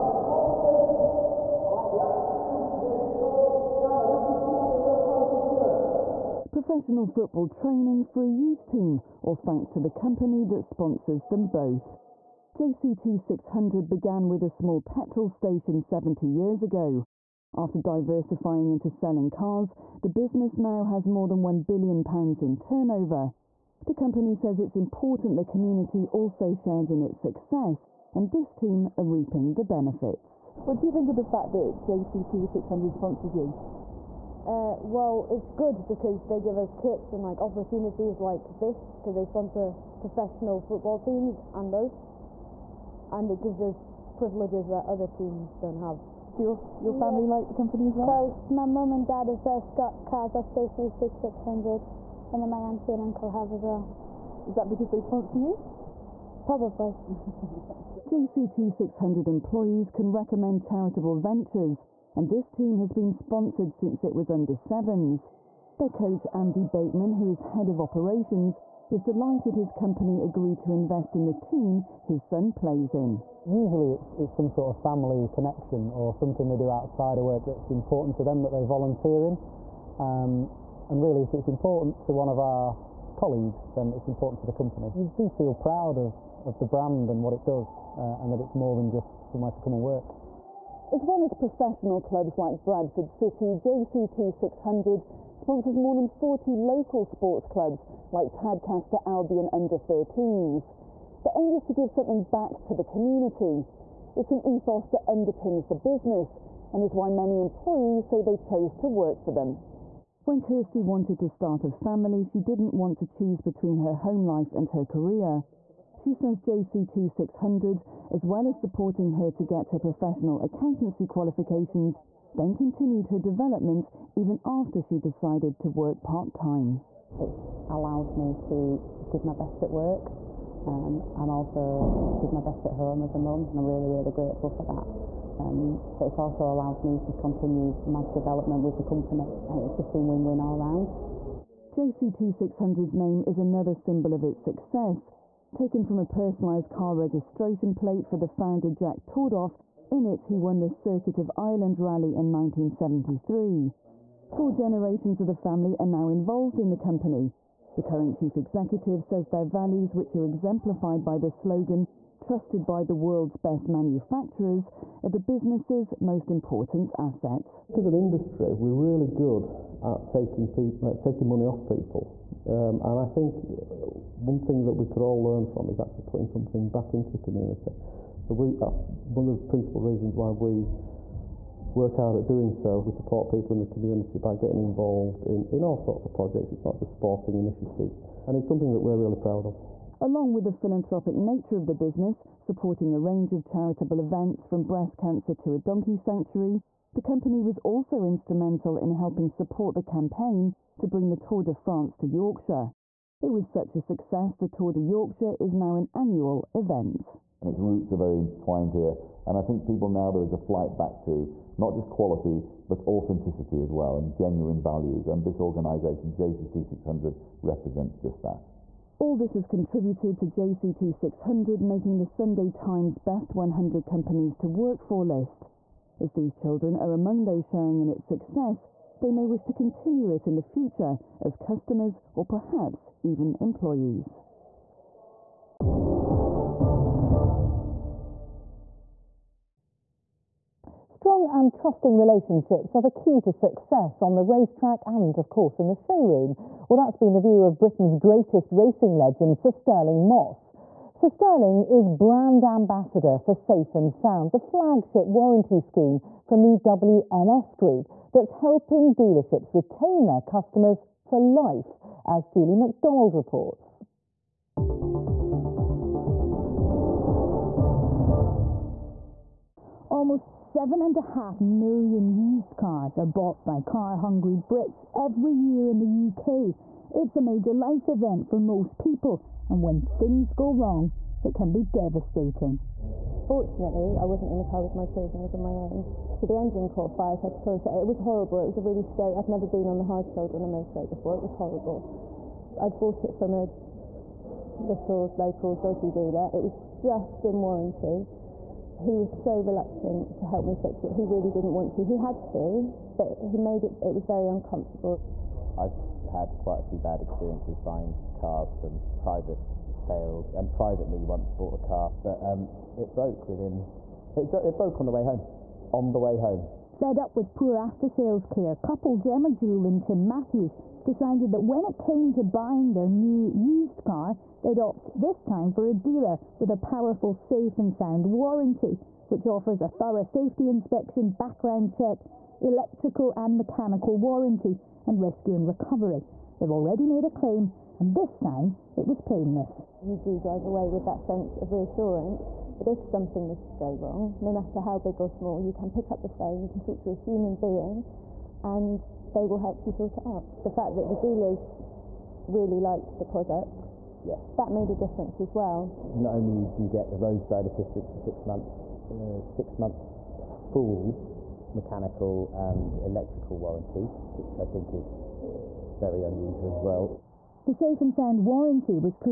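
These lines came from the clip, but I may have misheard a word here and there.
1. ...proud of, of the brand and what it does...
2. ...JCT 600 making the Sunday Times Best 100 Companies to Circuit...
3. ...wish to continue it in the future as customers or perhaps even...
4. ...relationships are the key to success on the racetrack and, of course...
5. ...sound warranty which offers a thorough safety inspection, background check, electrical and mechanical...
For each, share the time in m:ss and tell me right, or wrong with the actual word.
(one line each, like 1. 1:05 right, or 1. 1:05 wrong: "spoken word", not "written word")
1. 1:25 right
2. 3:40 wrong: "Work", not "Circuit"
3. 3:49 right
4. 4:01 right
5. 5:27 right.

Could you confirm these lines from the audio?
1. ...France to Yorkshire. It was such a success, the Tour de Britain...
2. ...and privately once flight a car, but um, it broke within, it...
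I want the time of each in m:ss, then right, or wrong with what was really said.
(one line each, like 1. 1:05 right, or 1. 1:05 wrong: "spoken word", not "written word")
1. 3:21 wrong: "Yorkshire", not "Britain"
2. 5:10 wrong: "bought", not "flight".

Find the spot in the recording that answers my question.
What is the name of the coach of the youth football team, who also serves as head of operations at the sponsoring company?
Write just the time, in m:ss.
1:06.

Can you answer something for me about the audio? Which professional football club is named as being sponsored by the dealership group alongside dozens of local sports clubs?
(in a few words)
Bradford City.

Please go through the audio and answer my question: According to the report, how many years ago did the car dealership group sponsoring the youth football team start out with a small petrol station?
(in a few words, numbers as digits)
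70 years.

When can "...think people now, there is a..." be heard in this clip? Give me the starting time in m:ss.
3:29.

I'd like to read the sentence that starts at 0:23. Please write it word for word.
The company says it's important the community also shares in its success, and this team are reaping the benefits.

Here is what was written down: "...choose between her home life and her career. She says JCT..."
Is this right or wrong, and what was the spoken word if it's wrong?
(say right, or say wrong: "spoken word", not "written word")
right.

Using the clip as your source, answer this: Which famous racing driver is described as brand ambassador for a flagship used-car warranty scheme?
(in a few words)
Sir Stirling Moss.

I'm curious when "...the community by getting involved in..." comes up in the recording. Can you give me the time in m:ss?
3:03.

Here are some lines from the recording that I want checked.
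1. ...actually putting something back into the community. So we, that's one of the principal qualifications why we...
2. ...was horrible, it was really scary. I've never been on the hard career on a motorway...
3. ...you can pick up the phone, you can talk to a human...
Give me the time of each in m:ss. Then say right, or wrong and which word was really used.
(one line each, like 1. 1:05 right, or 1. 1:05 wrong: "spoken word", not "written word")
1. 2:55 wrong: "reasons", not "qualifications"
2. 4:47 wrong: "shoulder", not "career"
3. 5:45 right.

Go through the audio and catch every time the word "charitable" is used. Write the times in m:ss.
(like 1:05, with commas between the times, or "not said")
1:00, 3:13.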